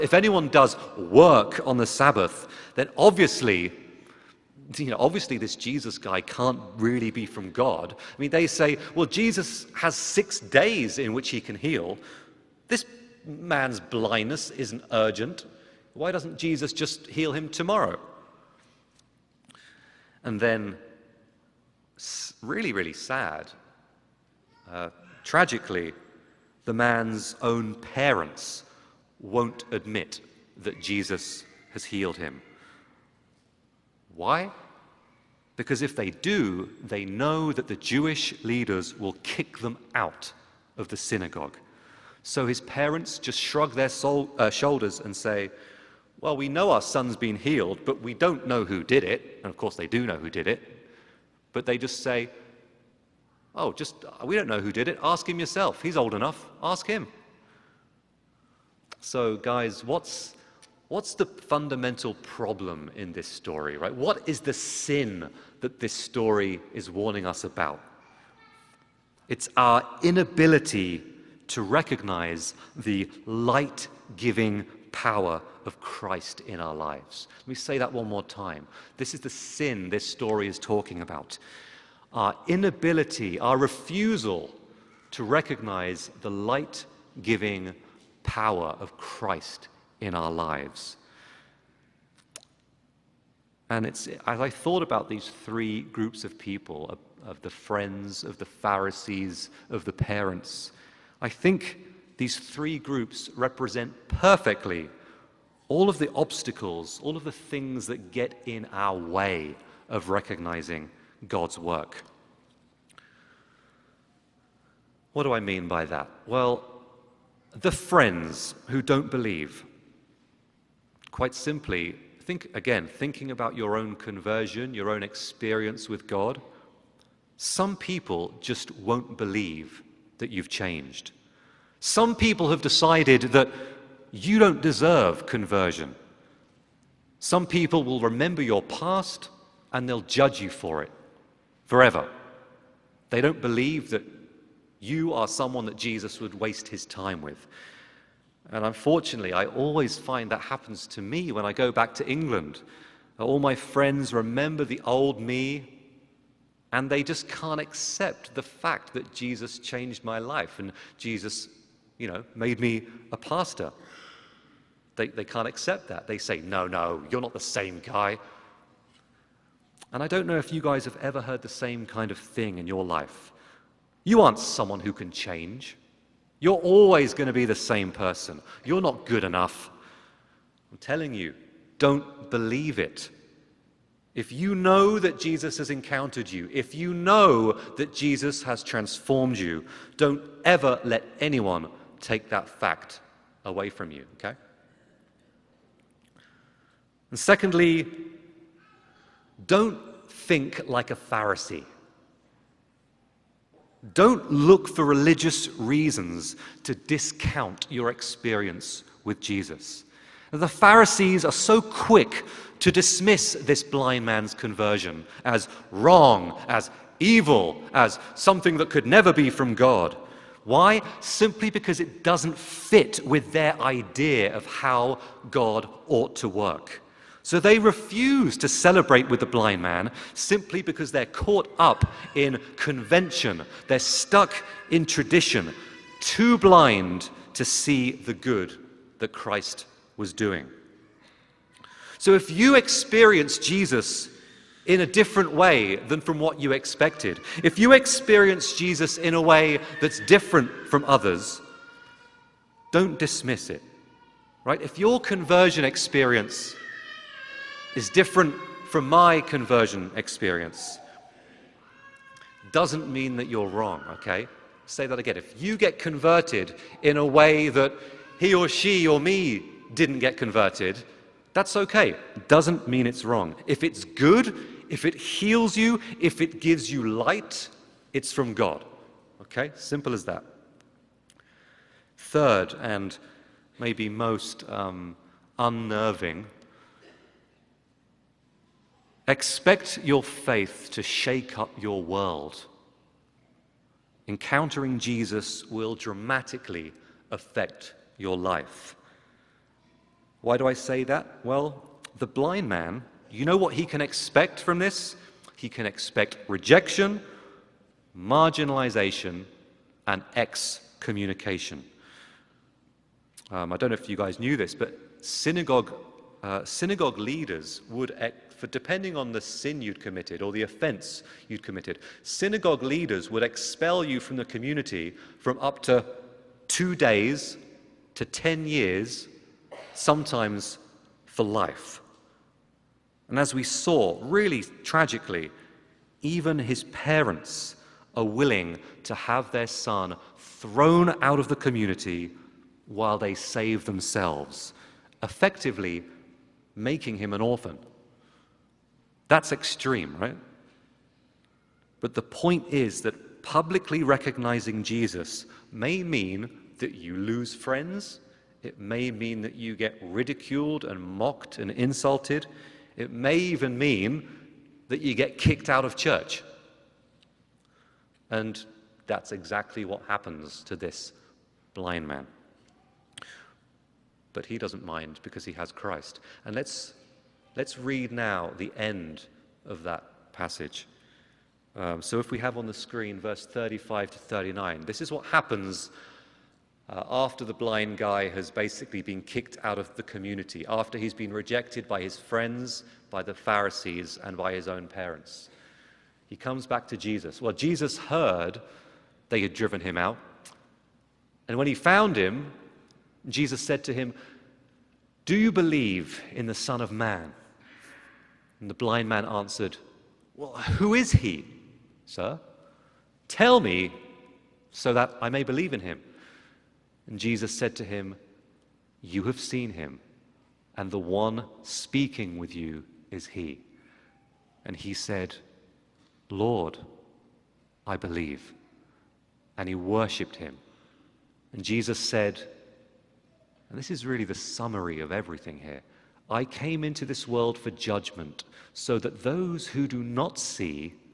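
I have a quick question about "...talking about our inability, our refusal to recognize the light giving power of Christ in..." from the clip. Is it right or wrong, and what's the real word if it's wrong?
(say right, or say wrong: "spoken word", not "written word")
right.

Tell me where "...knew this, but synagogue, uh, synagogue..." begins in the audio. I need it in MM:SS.
05:14.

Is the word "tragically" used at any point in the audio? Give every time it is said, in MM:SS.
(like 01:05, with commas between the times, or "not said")
00:25, 05:34.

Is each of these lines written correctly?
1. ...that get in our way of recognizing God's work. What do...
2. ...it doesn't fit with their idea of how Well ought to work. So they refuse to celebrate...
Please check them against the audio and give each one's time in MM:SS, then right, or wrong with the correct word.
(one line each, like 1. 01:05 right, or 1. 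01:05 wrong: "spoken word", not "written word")
1. 01:47 right
2. 03:41 wrong: "God", not "Well".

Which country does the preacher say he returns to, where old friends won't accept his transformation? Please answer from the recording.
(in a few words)
England.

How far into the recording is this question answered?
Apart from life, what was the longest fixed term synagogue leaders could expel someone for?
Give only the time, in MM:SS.
05:28.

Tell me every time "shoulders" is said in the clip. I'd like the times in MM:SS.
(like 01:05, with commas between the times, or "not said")
00:44.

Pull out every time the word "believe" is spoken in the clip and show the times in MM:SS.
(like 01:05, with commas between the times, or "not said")
01:59, 02:09, 02:23, 03:02, 06:45, 06:55, 07:07.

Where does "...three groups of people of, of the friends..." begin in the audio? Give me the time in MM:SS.
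01:35.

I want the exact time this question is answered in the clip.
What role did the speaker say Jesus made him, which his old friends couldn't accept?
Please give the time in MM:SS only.
02:43.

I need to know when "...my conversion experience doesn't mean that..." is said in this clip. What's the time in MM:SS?
04:18.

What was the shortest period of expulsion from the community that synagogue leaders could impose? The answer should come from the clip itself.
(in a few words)
2 days.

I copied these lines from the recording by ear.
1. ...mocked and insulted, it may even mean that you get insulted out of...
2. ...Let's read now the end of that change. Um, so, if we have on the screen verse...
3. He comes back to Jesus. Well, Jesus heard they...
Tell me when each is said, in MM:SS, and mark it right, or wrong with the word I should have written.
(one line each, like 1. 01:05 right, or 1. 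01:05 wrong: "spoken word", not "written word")
1. 06:00 wrong: "kicked", not "insulted"
2. 06:17 wrong: "passage", not "change"
3. 06:36 right.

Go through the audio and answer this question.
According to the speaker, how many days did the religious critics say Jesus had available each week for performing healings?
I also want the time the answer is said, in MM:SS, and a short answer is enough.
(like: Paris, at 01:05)
6, at 00:09.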